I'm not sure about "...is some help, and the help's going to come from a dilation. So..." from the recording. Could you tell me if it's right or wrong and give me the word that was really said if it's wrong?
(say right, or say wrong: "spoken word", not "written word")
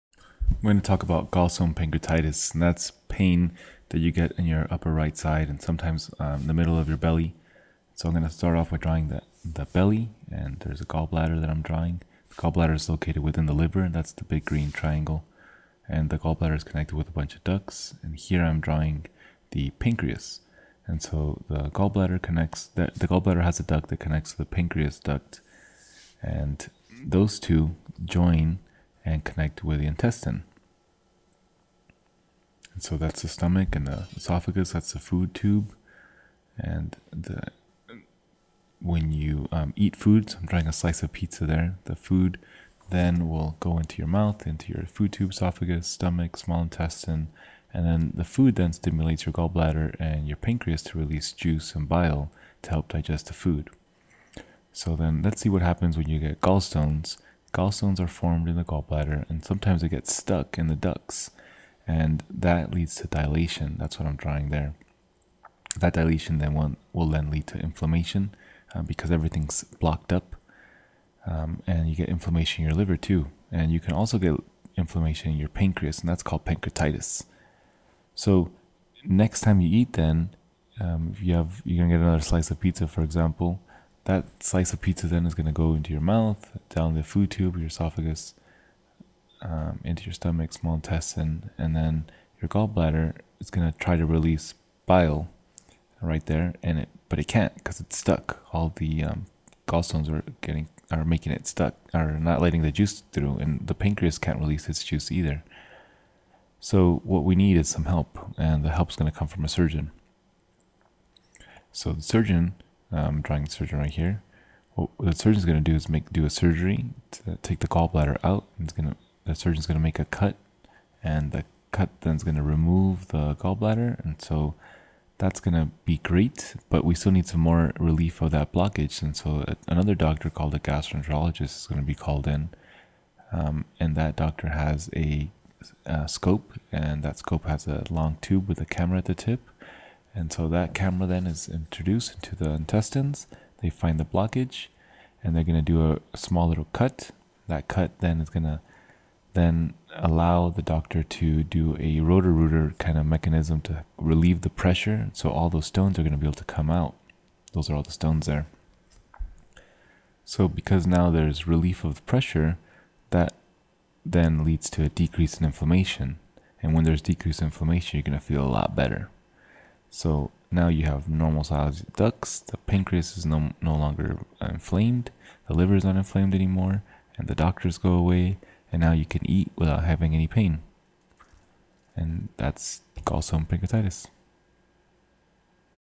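wrong: "surgeon", not "dilation".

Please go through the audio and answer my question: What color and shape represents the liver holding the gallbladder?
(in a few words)
big green triangle.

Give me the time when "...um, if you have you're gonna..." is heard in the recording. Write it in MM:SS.
01:20.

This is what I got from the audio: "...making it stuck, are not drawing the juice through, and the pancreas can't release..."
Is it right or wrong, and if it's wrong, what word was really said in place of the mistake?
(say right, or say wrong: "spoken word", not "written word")
wrong: "letting", not "drawing".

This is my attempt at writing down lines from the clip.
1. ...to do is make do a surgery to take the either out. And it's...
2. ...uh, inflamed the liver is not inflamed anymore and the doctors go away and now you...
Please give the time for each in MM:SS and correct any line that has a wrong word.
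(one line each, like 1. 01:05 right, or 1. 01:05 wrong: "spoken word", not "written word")
1. 01:55 wrong: "gallbladder", not "either"
2. 02:54 right.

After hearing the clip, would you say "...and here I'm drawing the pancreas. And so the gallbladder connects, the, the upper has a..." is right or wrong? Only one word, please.
wrong.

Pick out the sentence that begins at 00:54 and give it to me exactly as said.
So then let's see what happens when you get gallstones.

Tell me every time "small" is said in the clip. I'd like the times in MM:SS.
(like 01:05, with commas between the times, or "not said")
00:46, 01:30, 02:26.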